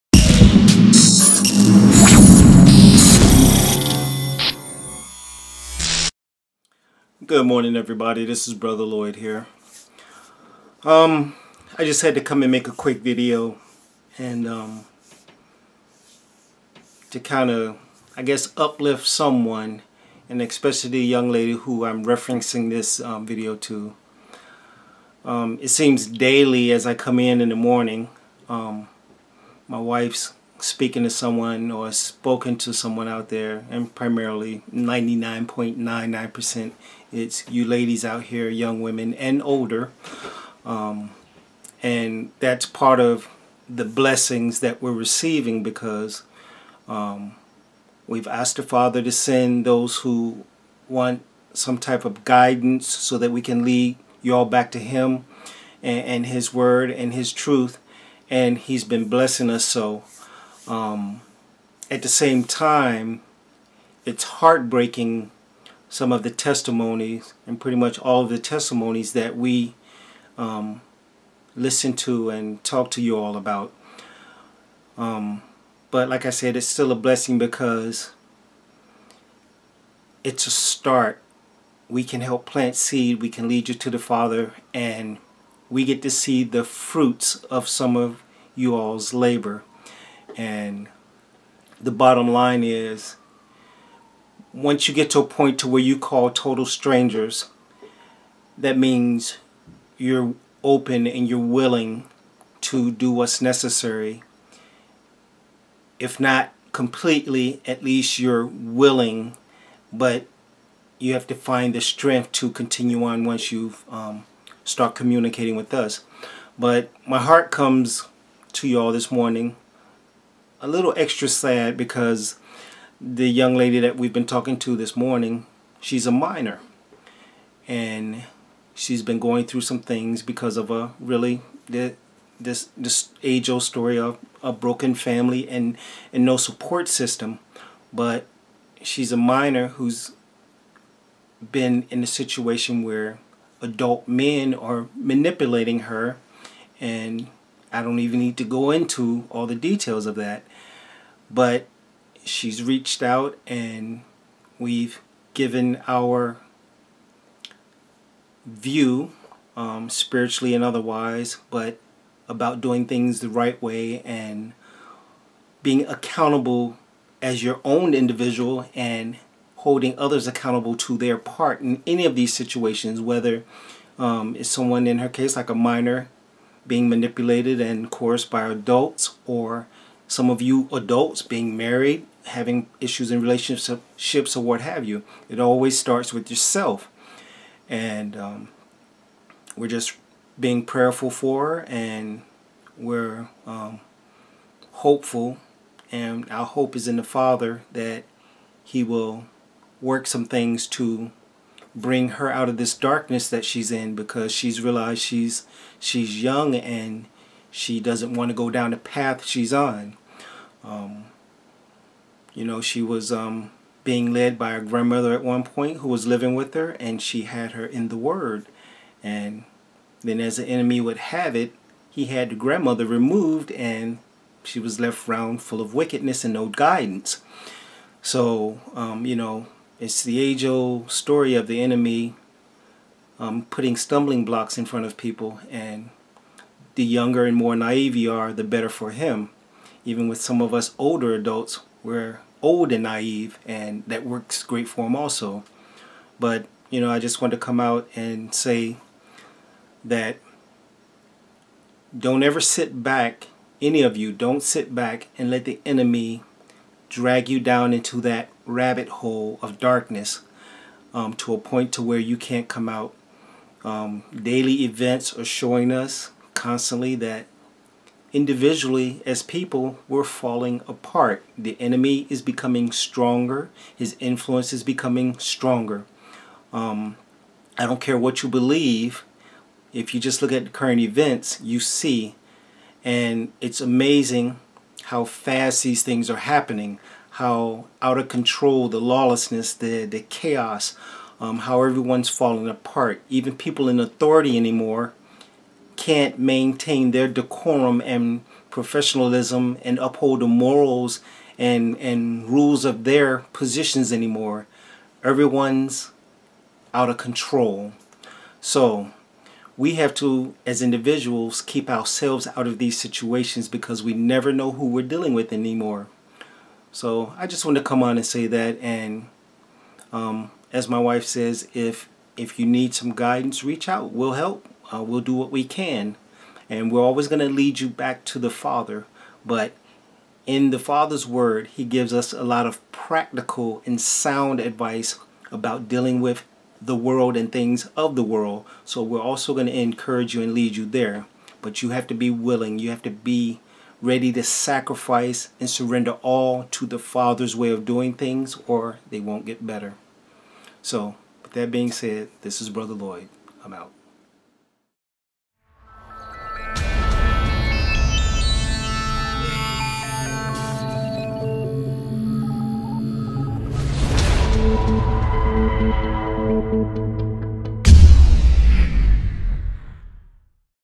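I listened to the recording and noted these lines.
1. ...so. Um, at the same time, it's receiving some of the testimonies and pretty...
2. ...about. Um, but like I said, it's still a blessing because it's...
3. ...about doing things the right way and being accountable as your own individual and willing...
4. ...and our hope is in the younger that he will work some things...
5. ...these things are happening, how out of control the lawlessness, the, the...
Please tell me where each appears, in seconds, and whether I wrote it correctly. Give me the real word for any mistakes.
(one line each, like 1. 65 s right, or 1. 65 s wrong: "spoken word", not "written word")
1. 59 s wrong: "heartbreaking", not "receiving"
2. 73 s right
3. 162 s wrong: "holding", not "willing"
4. 195 s wrong: "father", not "younger"
5. 285 s right.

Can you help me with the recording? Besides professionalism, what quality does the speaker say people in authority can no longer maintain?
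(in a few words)
decorum.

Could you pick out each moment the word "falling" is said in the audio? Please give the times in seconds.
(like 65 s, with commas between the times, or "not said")
270 s, 292 s.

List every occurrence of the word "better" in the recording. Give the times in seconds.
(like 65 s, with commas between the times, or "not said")
238 s, 349 s.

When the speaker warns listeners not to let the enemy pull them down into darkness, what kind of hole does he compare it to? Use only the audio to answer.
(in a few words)
rabbit hole.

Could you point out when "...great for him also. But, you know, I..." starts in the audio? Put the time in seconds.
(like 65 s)
244 s.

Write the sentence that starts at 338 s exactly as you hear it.
So we're also going to encourage you and lead you there.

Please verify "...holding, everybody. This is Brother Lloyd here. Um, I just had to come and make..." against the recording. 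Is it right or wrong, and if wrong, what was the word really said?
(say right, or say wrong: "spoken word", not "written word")
wrong: "morning", not "holding".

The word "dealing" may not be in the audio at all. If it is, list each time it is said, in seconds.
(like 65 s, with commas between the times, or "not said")
314 s, 335 s.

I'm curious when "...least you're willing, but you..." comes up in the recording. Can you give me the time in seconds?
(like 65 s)
107 s.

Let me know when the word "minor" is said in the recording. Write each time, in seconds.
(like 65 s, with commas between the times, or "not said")
126 s, 139 s, 175 s.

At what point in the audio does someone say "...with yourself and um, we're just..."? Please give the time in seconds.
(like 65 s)
186 s.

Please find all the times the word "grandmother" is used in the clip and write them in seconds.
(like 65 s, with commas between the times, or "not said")
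214 s, 222 s.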